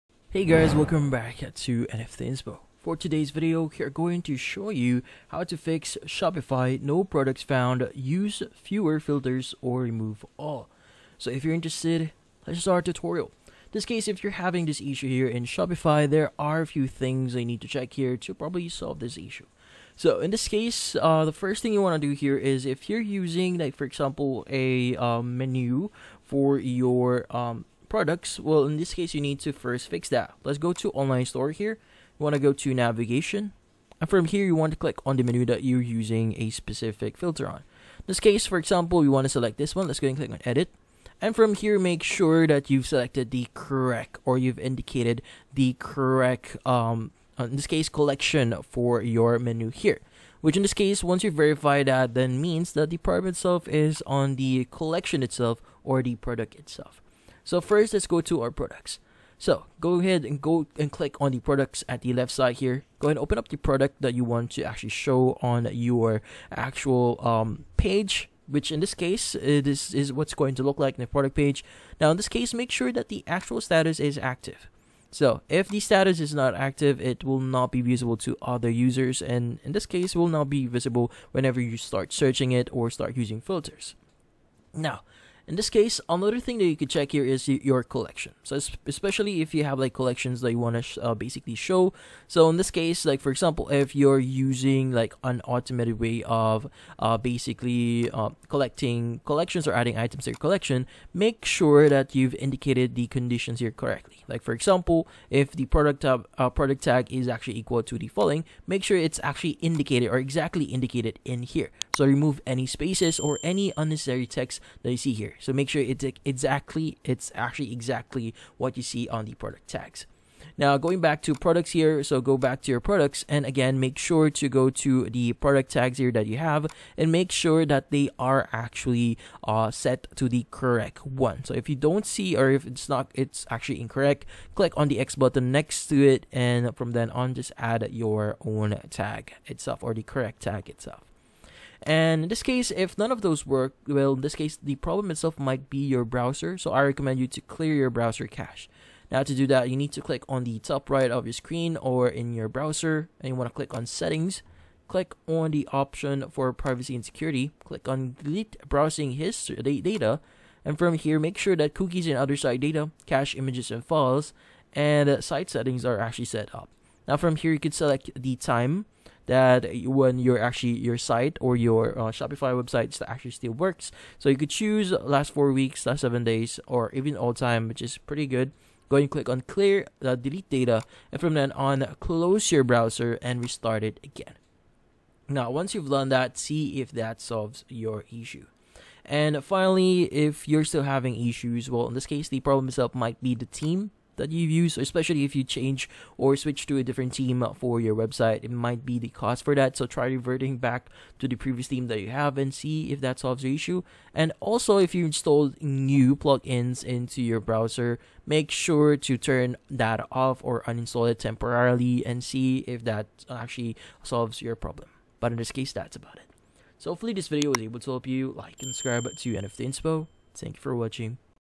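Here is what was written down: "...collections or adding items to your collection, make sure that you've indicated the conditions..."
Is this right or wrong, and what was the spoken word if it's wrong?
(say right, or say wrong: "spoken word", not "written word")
right.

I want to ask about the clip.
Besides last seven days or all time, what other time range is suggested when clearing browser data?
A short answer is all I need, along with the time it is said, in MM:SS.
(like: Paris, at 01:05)
Last 4 weeks, at 02:54.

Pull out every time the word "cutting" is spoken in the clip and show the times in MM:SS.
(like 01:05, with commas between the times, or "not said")
not said.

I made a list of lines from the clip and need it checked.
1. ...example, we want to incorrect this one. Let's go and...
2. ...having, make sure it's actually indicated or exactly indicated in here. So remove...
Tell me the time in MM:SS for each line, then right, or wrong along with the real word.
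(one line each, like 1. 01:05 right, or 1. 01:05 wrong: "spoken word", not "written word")
1. 00:38 wrong: "select", not "incorrect"
2. 01:48 wrong: "following", not "having".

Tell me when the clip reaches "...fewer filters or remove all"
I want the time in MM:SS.
00:08.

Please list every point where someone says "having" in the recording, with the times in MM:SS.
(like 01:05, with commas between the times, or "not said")
00:14, 03:10.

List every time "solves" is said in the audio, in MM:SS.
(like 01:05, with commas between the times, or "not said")
00:18, 03:07, 03:23, 03:34.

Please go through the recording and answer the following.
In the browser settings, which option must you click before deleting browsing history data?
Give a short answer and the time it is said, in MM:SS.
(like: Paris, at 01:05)
Privacy and security, at 02:36.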